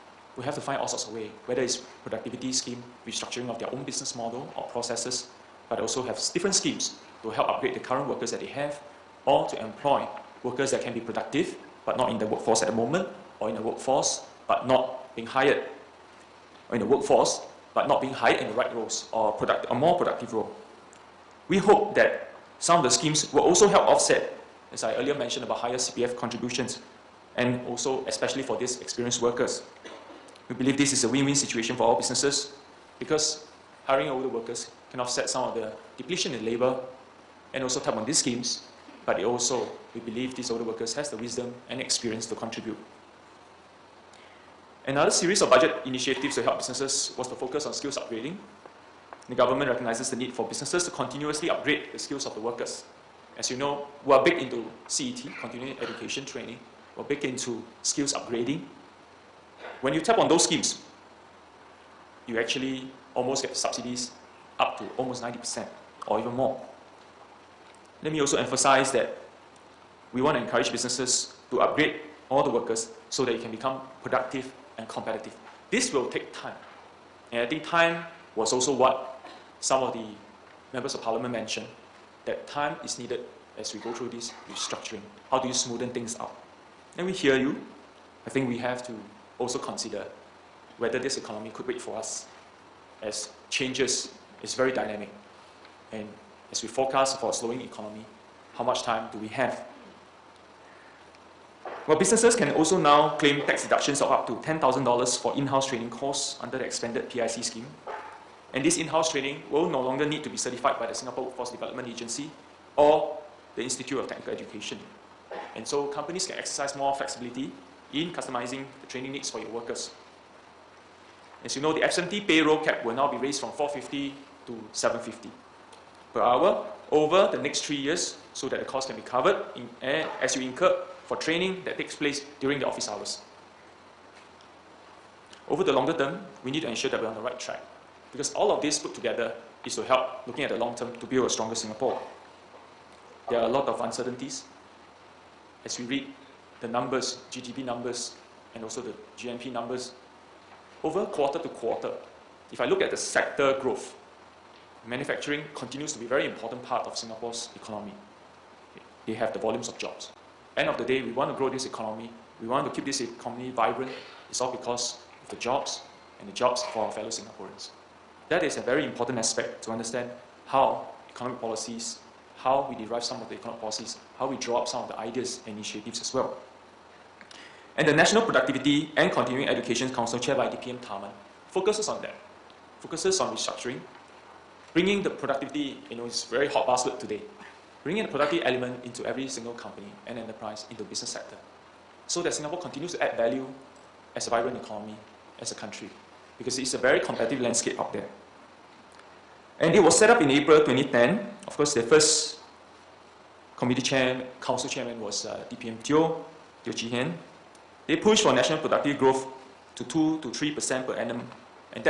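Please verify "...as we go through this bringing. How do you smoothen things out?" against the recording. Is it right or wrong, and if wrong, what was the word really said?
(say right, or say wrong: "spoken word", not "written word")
wrong: "restructuring", not "bringing".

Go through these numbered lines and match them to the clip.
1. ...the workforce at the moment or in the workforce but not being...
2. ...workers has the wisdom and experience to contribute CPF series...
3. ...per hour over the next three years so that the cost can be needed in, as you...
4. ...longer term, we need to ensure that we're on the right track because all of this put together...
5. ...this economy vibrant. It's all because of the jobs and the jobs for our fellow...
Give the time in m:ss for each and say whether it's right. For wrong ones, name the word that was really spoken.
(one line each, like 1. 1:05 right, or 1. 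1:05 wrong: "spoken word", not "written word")
1. 0:12 right
2. 0:40 wrong: "Another", not "CPF"
3. 2:06 wrong: "covered", not "needed"
4. 2:15 right
5. 2:42 right.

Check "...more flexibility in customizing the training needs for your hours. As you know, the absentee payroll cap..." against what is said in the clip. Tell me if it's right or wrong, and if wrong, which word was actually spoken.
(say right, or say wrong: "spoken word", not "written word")
wrong: "workers", not "hours".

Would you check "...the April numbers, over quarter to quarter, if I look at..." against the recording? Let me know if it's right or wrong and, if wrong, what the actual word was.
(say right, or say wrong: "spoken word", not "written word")
wrong: "GNP", not "April".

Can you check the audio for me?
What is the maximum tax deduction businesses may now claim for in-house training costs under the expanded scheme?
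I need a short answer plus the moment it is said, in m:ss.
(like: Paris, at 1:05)
$10,000, at 1:44.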